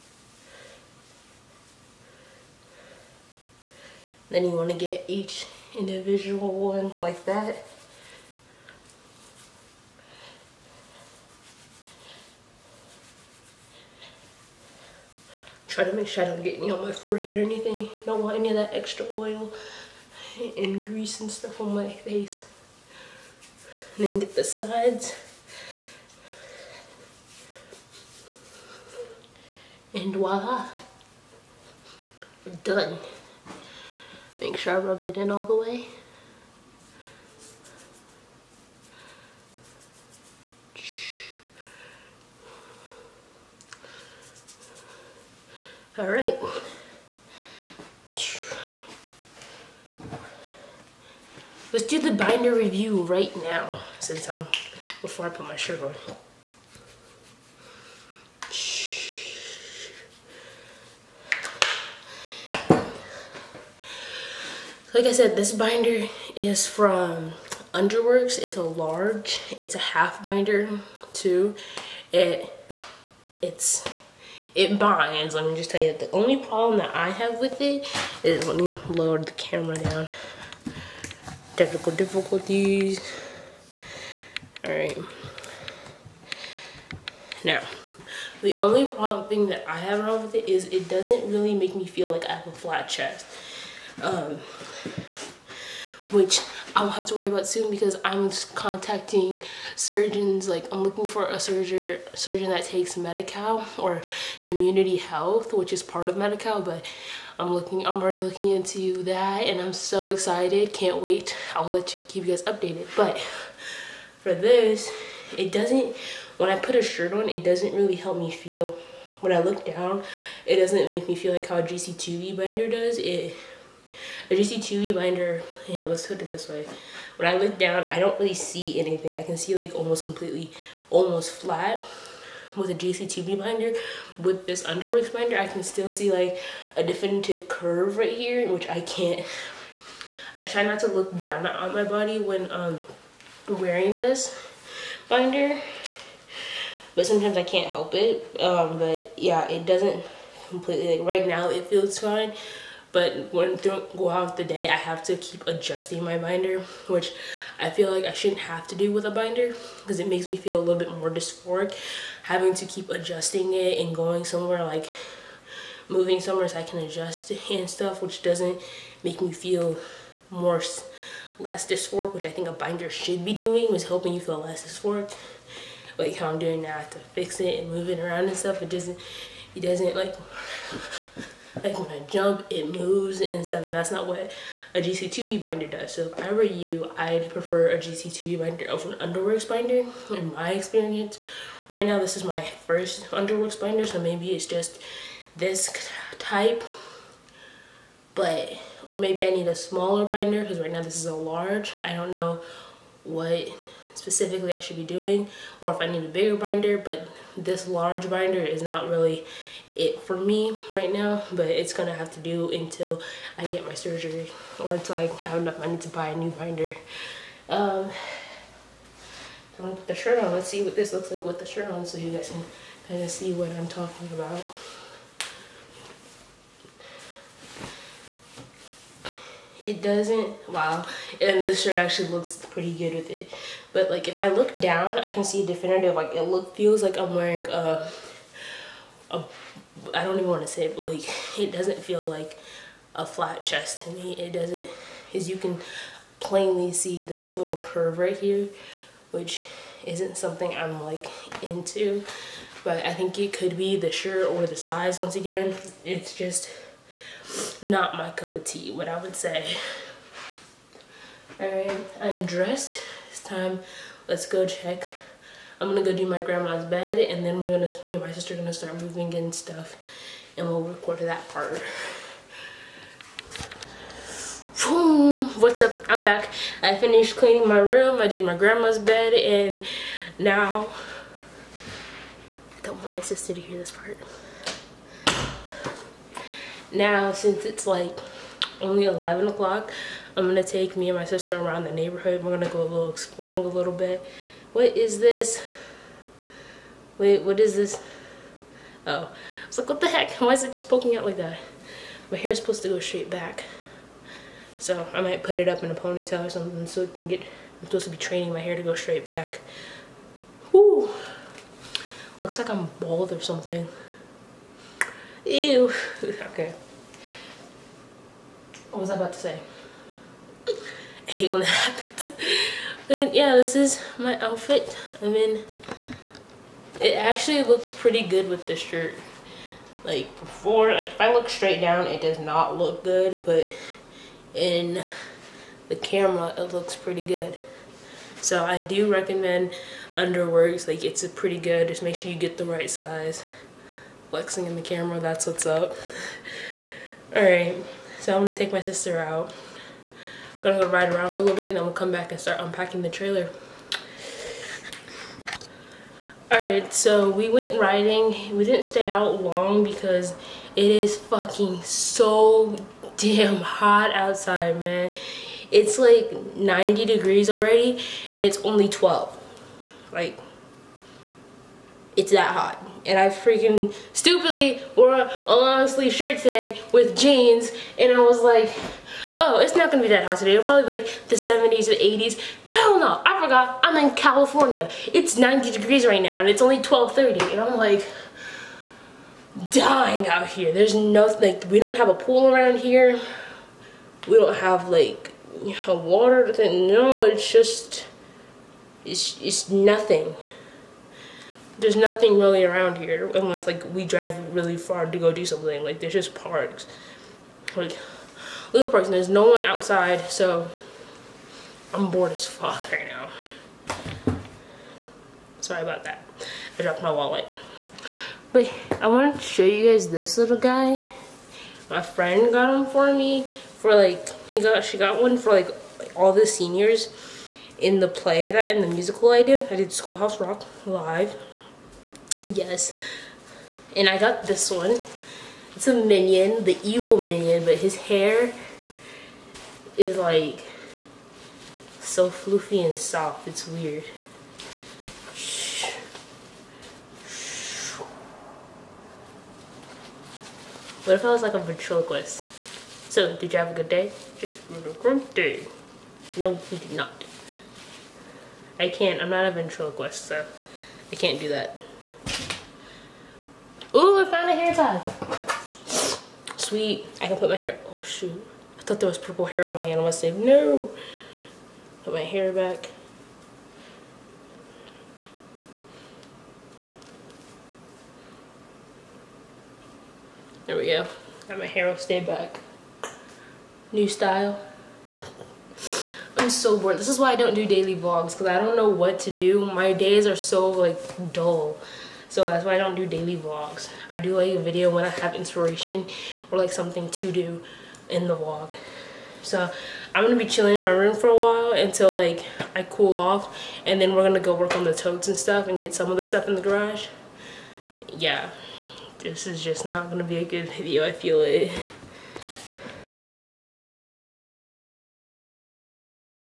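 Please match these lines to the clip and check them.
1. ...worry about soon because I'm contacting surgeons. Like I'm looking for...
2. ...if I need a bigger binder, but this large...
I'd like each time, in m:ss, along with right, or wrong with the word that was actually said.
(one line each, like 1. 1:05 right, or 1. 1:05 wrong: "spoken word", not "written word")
1. 1:37 right
2. 3:25 right.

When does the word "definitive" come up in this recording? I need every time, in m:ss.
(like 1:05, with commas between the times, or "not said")
2:16, 3:55.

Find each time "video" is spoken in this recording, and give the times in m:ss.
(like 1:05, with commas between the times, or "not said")
8:14, 8:30.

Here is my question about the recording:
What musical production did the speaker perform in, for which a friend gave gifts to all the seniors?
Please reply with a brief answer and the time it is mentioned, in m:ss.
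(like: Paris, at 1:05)
Schoolhouse Rock Live, at 7:09.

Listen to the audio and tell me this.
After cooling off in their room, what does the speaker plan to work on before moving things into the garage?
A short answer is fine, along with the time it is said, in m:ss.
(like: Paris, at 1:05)
Totes, at 8:24.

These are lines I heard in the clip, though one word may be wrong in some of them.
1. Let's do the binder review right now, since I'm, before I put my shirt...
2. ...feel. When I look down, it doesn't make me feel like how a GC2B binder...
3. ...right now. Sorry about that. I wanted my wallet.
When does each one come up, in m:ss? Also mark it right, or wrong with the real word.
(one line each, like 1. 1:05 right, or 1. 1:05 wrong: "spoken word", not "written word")
1. 0:51 right
2. 1:58 right
3. 6:52 wrong: "dropped", not "wanted".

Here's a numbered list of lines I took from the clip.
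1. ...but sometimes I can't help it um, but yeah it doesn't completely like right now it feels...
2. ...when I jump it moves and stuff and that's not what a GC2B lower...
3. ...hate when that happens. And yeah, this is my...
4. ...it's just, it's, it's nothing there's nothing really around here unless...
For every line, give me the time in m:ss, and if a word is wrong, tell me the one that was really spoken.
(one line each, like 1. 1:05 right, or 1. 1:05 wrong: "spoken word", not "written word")
1. 2:26 right
2. 3:01 wrong: "binder", not "lower"
3. 5:21 right
4. 6:37 right.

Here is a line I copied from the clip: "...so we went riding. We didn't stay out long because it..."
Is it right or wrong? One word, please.
right.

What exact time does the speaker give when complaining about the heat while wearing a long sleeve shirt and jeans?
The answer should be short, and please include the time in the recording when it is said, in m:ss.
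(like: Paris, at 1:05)
12:30, at 6:26.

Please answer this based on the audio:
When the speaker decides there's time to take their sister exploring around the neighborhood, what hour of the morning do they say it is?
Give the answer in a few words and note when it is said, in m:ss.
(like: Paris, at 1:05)
11 o'clock, at 4:48.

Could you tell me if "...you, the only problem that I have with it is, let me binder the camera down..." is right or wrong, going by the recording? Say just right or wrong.
wrong.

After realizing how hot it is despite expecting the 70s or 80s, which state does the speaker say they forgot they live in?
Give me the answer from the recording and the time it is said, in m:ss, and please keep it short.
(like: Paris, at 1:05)
California, at 6:23.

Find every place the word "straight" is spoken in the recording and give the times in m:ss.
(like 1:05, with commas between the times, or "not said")
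5:02, 5:08, 5:31.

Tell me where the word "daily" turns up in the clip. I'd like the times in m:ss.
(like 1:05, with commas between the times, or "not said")
8:07, 8:12.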